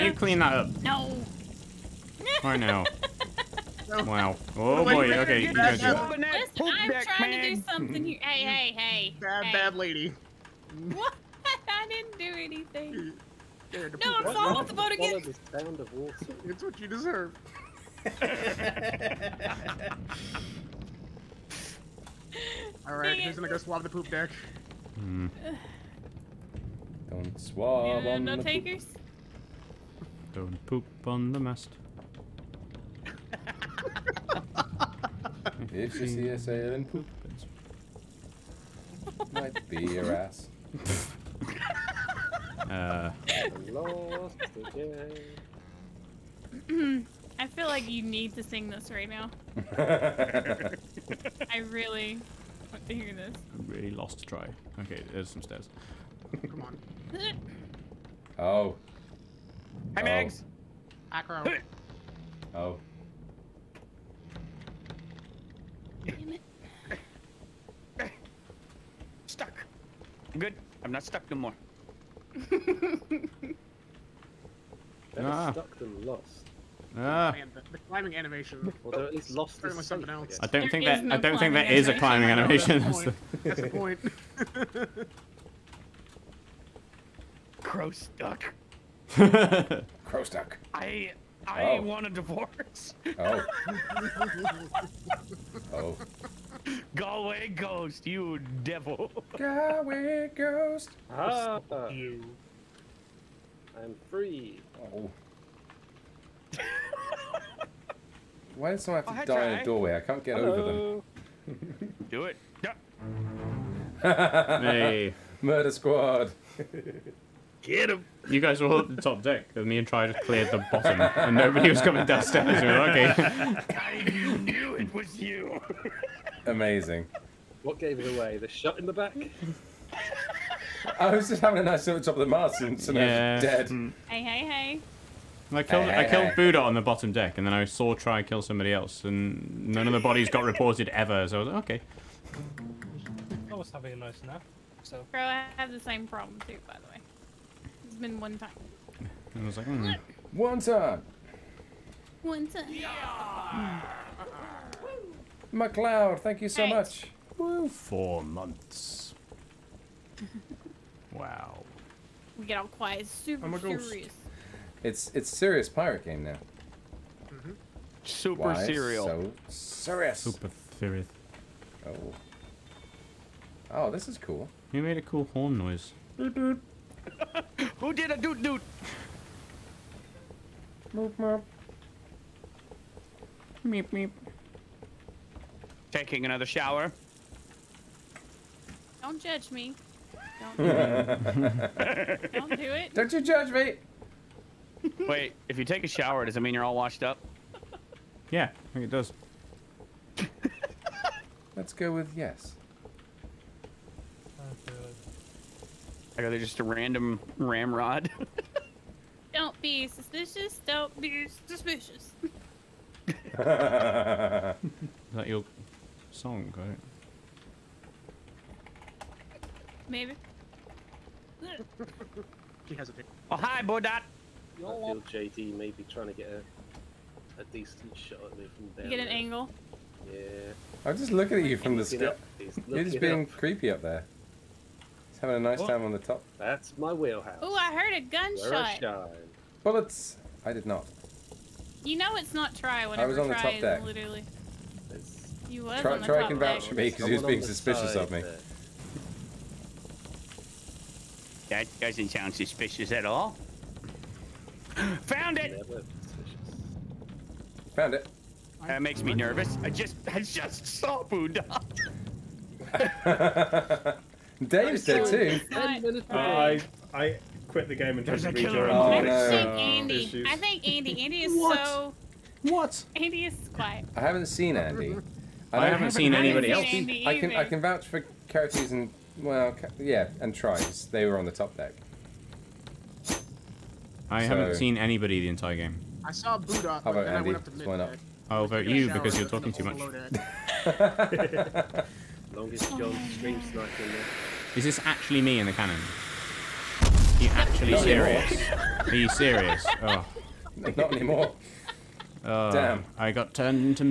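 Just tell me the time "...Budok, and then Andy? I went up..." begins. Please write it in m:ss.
4:46.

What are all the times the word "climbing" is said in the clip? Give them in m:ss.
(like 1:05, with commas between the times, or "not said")
1:17, 1:21.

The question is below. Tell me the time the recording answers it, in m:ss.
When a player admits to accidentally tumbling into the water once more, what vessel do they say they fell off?
0:14.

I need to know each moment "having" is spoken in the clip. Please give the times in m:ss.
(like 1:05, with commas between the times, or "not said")
2:11, 2:23, 3:55.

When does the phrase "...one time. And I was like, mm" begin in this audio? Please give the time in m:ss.
2:28.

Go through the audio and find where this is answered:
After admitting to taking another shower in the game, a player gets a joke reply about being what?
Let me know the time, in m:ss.
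3:16.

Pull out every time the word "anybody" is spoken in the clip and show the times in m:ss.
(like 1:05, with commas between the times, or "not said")
4:36, 4:44.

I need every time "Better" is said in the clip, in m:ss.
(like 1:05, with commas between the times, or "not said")
1:12.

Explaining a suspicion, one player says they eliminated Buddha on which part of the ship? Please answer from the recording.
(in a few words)
bottom deck.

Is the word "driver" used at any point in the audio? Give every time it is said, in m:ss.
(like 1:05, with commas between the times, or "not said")
not said.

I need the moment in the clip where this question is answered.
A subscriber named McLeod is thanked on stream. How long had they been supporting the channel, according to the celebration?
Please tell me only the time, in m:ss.
2:37.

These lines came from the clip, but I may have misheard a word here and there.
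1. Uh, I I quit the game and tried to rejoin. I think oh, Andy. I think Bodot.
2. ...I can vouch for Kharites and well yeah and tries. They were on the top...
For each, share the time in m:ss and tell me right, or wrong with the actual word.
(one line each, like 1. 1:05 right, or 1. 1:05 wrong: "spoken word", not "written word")
1. 4:25 wrong: "Andy", not "Bodot"
2. 4:37 right.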